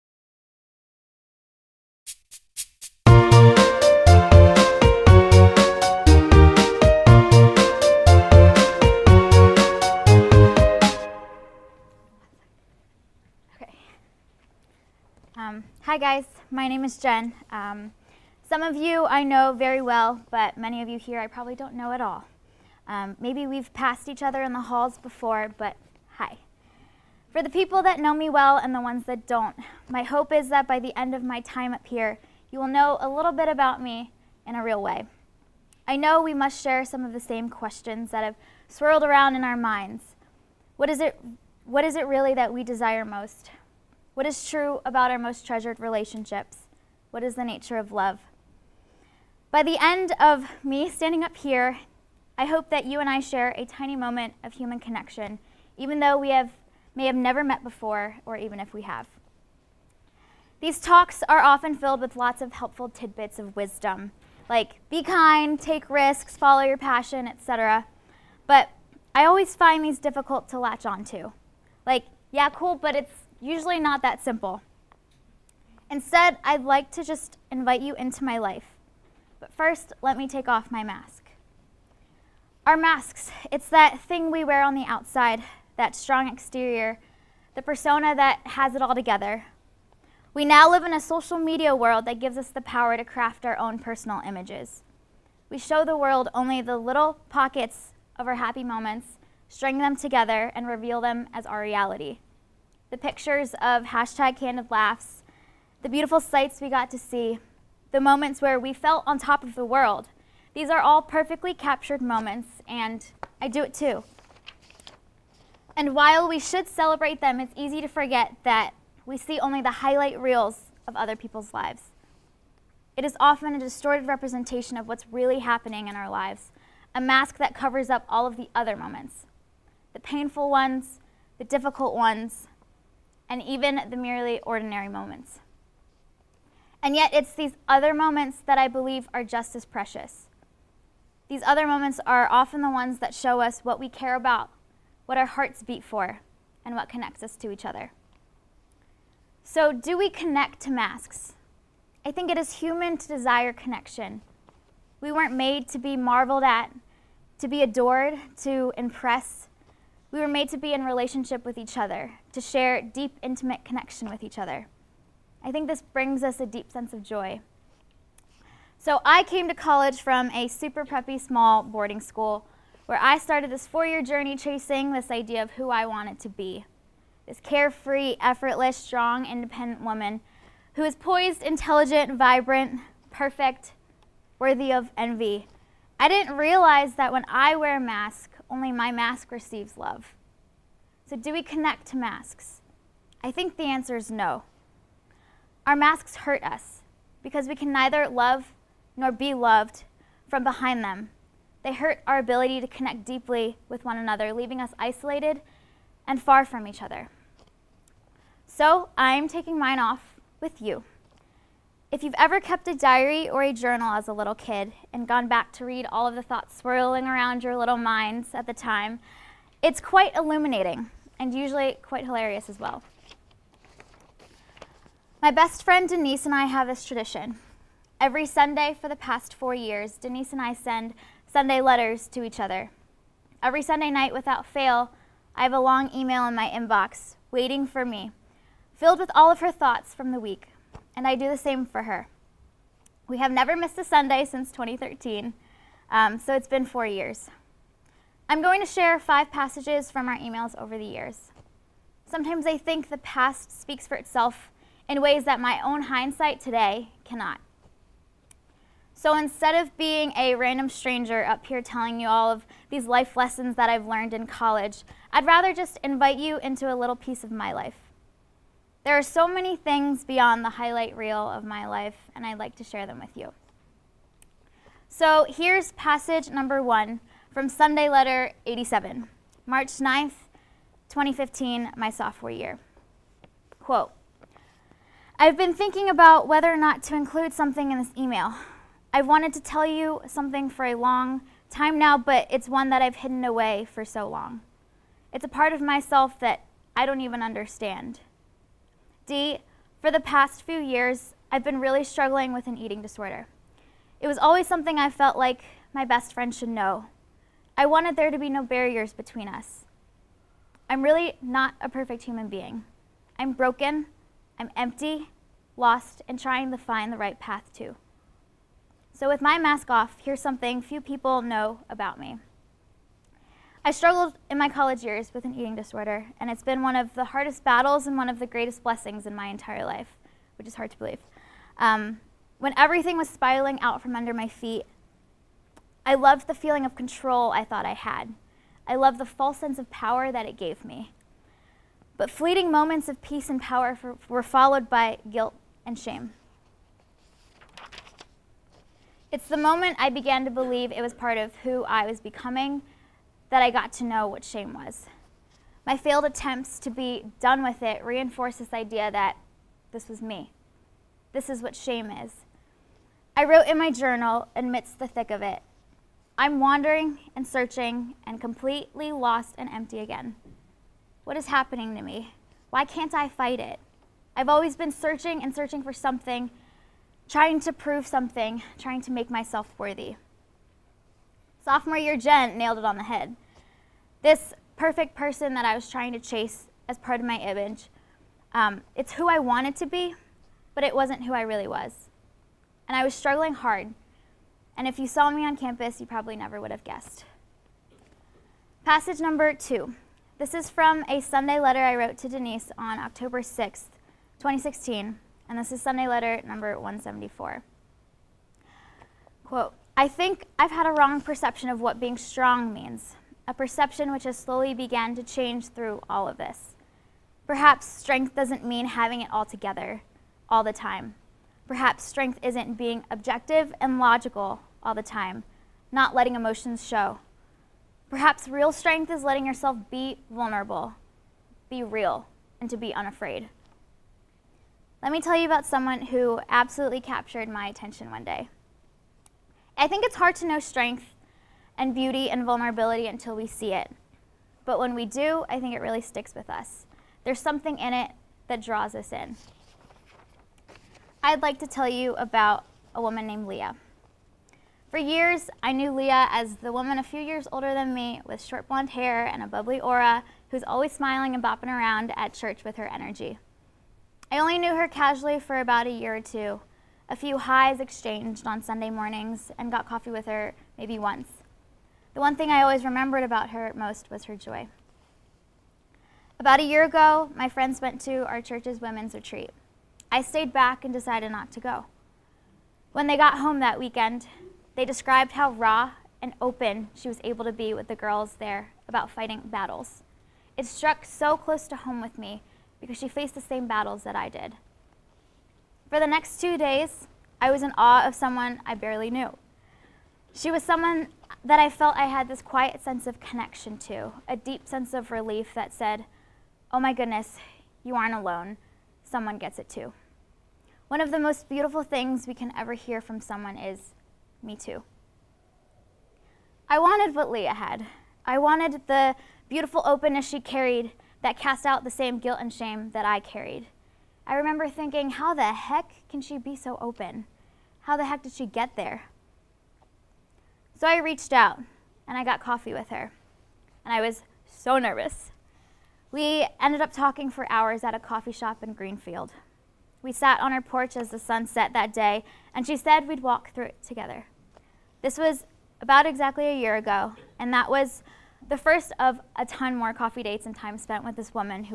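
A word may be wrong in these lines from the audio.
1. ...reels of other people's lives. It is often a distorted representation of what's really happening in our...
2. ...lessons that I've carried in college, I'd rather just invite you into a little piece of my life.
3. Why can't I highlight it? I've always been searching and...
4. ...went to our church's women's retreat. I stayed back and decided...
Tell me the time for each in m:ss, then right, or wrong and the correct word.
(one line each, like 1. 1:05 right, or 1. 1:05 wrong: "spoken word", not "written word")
1. 2:00 right
2. 4:23 wrong: "learned", not "carried"
3. 6:12 wrong: "fight", not "highlight"
4. 7:57 right.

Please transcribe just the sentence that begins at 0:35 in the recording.
I know we must share some of the same questions that have swirled around in our minds.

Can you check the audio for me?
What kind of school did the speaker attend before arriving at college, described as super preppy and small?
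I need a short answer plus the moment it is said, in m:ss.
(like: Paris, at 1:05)
boarding school, at 2:51.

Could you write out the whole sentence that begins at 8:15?
For the next two days, I was in awe of someone I barely knew.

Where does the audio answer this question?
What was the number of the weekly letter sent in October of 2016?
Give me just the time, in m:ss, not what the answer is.
6:45.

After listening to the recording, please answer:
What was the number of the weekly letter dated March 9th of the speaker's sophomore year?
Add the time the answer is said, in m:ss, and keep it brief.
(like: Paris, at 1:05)
87, at 4:37.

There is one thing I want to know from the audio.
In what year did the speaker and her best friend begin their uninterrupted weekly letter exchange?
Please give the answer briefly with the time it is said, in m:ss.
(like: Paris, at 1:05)
2013, at 4:04.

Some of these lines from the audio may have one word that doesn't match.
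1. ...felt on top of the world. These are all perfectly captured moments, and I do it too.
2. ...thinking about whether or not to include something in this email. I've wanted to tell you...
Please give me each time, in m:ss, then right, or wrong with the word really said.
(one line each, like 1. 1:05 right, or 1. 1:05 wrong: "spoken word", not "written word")
1. 1:48 right
2. 4:45 right.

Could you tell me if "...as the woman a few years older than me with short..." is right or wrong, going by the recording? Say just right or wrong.
right.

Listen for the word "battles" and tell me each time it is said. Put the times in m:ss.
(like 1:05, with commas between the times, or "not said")
5:27, 8:09, 8:13.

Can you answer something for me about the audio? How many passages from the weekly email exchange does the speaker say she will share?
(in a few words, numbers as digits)
5.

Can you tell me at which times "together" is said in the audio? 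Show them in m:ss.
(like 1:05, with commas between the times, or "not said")
1:28, 1:39, 6:59, 9:03.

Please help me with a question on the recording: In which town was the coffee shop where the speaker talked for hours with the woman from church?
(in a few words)
Greenfield.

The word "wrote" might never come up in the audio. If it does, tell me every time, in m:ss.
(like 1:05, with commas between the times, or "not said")
6:03, 6:41.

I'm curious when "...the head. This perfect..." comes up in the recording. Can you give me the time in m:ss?
6:22.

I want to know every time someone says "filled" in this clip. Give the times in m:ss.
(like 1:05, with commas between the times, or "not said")
1:01, 3:58.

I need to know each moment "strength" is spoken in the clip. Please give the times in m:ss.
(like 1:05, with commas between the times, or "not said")
6:57, 7:01, 7:08, 7:20.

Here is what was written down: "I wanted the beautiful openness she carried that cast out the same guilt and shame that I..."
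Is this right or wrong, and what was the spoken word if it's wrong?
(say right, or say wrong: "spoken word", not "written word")
right.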